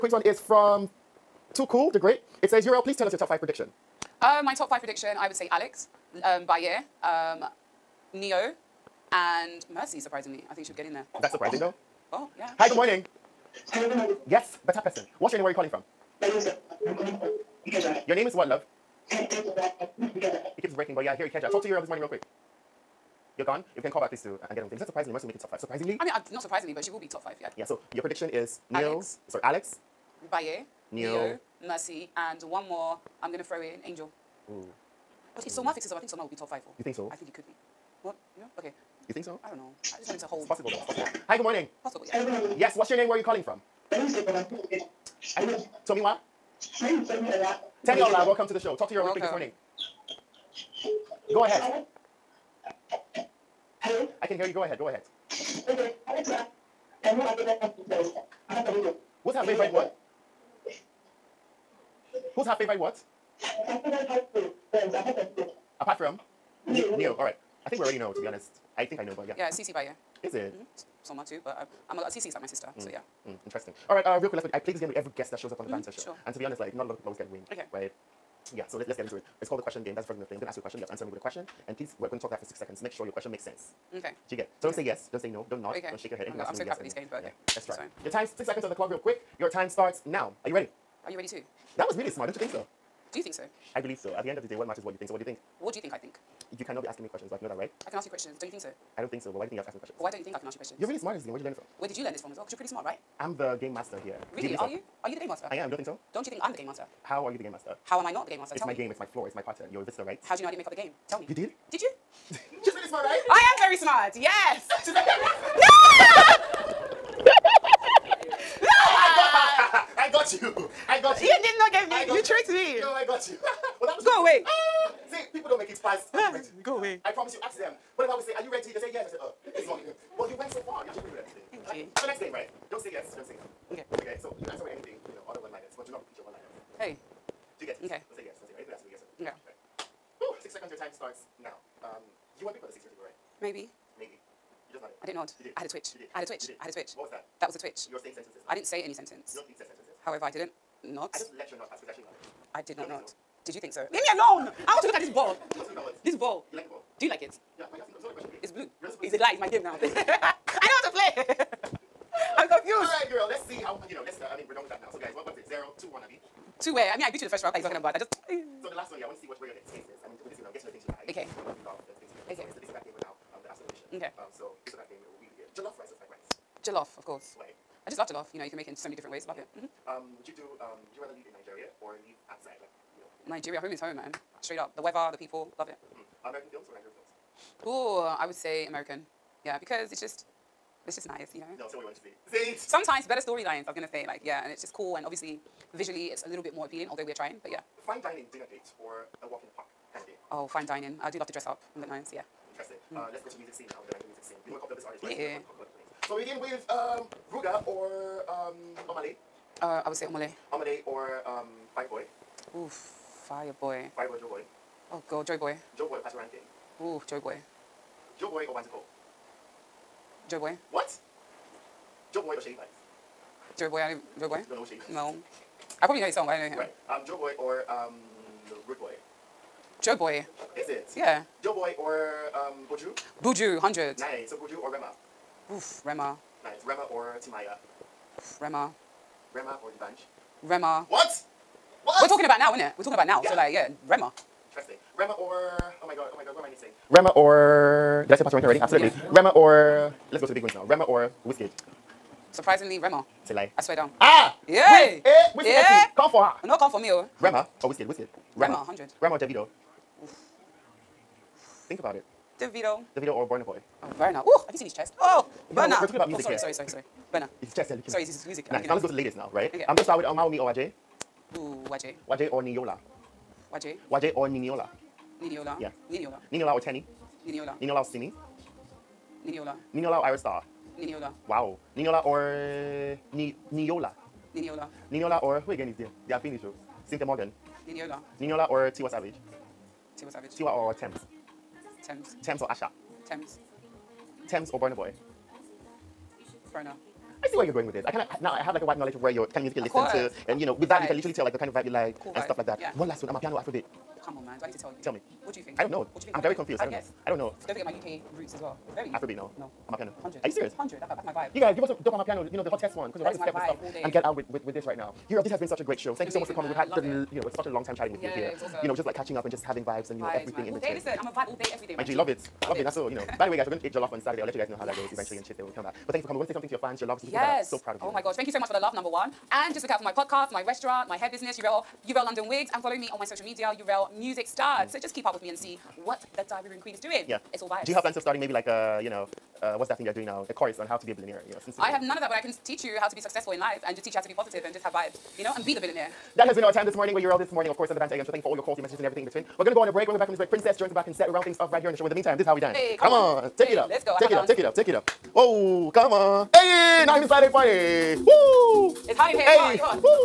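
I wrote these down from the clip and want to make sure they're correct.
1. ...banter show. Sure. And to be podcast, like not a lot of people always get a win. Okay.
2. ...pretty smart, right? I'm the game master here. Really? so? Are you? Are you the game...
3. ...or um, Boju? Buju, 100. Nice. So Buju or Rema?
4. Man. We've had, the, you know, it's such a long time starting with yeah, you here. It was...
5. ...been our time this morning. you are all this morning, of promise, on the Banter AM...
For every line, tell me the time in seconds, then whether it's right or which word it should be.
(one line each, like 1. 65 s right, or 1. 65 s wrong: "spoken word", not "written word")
1. 75 s wrong: "honest", not "podcast"
2. 102 s right
3. 231 s right
4. 316 s wrong: "chatting", not "starting"
5. 346 s wrong: "course", not "promise".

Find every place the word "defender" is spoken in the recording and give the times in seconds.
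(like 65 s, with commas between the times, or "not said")
not said.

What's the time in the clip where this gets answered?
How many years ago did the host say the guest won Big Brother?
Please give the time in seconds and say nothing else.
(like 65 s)
142 s.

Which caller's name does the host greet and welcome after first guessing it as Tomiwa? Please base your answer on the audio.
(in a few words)
Teniola.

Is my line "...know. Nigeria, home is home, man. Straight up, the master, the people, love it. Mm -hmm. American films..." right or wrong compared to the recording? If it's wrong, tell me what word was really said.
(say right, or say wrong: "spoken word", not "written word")
wrong: "weather", not "master".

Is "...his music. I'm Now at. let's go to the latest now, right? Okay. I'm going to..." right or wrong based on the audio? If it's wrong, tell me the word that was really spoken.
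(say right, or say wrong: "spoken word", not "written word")
right.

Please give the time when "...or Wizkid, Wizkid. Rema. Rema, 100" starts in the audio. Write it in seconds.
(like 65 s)
257 s.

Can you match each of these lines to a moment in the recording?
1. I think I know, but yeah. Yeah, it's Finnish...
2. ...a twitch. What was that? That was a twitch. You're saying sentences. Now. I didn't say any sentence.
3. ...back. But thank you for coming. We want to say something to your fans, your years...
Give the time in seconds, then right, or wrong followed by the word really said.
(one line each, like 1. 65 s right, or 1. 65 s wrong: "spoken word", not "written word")
1. 68 s wrong: "CeeC", not "Finnish"
2. 146 s right
3. 325 s wrong: "lovers", not "years".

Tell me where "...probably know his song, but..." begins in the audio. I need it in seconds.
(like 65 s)
225 s.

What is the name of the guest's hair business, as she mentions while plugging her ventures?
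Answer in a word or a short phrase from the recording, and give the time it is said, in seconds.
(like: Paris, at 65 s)
Uriel London Wigs, at 331 s.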